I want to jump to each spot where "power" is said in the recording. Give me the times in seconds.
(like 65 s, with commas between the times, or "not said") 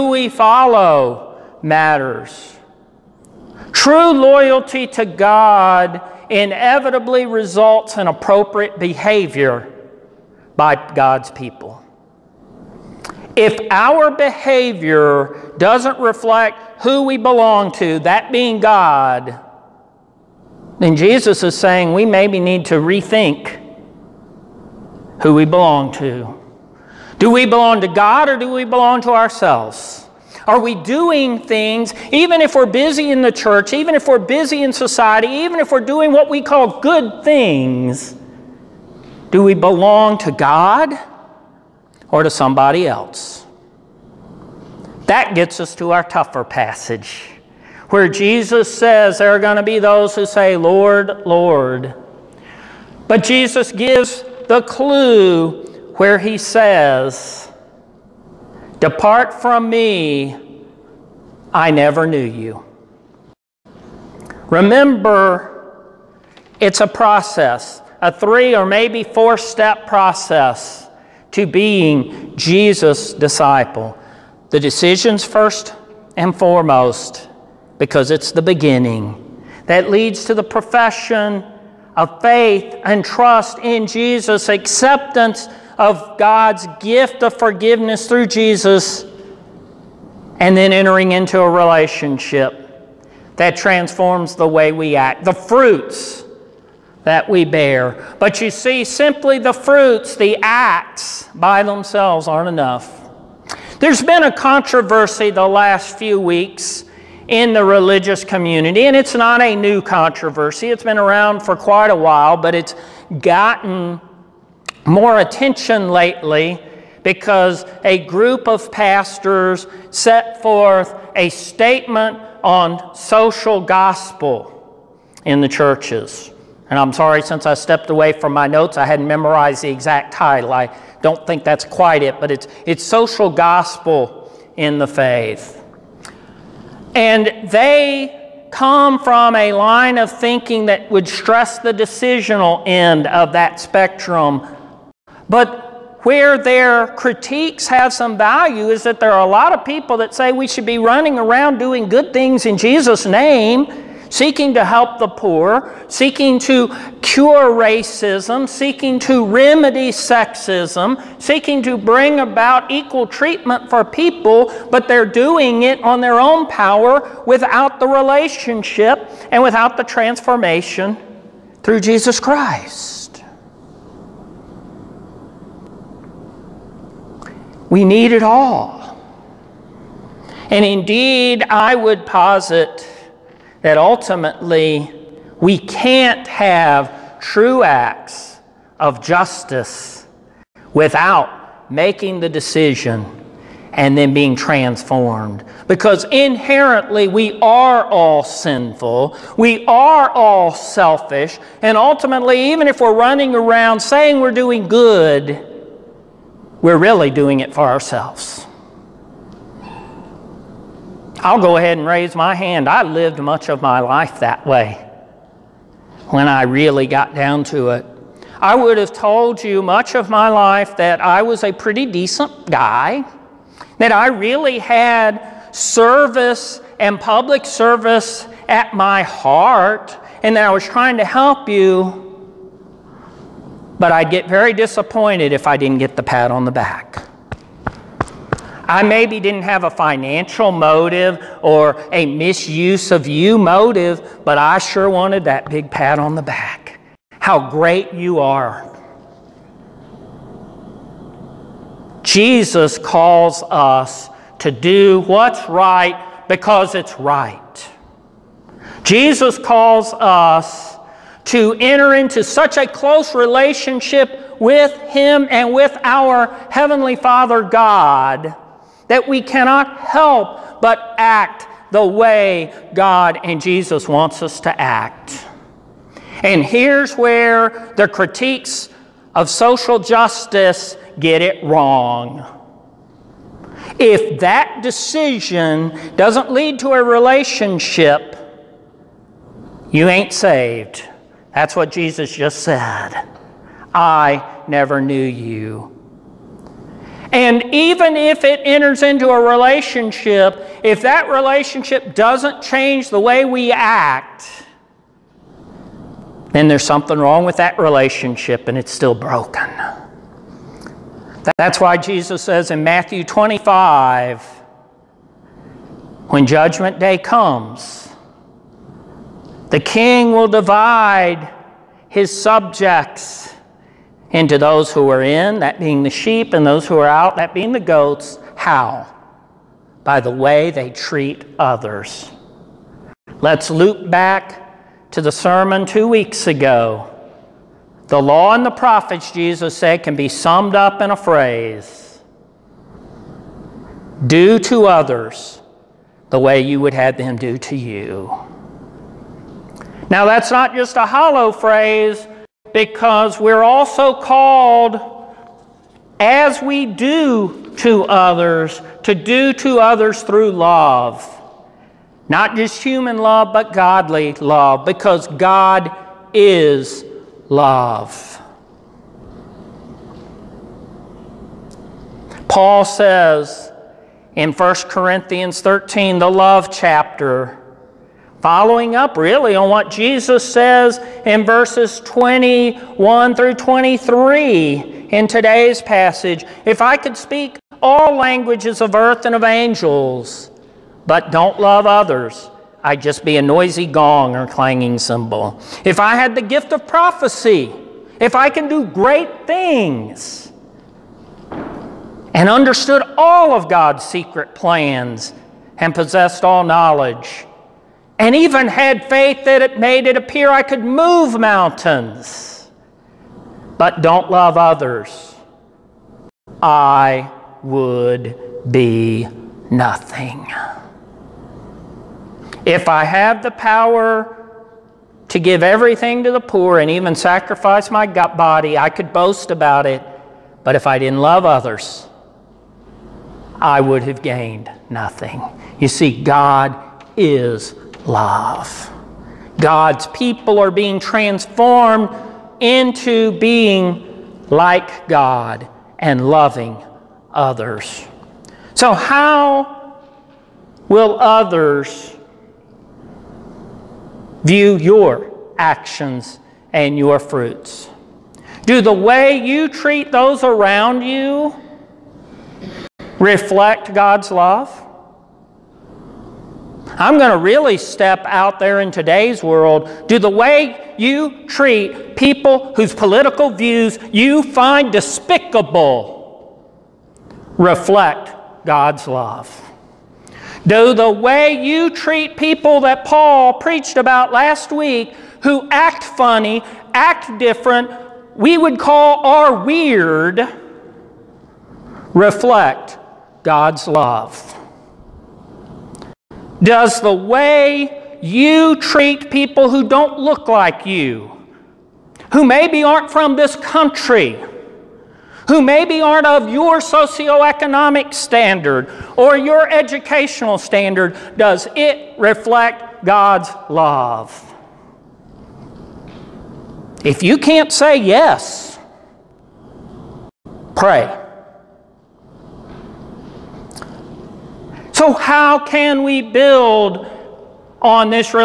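166 s, 423 s.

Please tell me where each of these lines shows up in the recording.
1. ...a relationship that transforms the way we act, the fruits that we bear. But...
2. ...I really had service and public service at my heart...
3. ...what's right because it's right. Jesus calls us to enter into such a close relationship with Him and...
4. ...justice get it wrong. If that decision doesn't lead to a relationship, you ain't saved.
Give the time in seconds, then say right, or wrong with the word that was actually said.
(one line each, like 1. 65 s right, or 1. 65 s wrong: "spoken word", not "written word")
1. 91 s right
2. 223 s right
3. 255 s right
4. 279 s right.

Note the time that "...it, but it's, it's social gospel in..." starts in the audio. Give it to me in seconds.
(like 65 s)
132 s.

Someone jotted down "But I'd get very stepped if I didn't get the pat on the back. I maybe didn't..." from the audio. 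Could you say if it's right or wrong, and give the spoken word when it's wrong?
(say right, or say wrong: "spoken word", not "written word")
wrong: "disappointed", not "stepped".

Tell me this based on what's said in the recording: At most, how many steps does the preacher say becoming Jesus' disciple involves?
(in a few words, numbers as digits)
4.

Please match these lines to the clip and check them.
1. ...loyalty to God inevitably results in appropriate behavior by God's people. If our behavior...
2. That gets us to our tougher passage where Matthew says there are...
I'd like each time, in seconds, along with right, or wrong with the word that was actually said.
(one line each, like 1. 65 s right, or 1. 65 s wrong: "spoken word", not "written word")
1. 4 s right
2. 45 s wrong: "Jesus", not "Matthew".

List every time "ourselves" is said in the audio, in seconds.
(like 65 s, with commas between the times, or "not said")
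29 s, 207 s.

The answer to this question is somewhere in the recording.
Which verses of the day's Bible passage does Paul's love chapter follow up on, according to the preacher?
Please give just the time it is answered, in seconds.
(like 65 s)
381 s.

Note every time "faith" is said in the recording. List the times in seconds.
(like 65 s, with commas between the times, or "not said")
82 s, 134 s, 408 s.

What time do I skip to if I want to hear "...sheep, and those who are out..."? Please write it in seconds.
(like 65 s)
325 s.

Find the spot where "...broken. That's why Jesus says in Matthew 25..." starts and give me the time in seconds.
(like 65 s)
308 s.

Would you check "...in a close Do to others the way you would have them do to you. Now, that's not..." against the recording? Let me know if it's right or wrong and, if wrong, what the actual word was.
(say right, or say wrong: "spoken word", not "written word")
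wrong: "phrase", not "close".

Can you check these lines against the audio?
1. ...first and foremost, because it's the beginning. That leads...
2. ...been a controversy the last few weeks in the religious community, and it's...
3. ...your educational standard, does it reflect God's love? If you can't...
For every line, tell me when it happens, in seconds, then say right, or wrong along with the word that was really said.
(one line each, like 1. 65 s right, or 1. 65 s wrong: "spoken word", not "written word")
1. 75 s right
2. 104 s right
3. 509 s right.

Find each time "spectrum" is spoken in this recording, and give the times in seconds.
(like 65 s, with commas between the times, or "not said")
143 s.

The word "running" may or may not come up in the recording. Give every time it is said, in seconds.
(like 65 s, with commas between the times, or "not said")
150 s, 202 s.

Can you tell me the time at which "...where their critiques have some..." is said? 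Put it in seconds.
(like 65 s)
146 s.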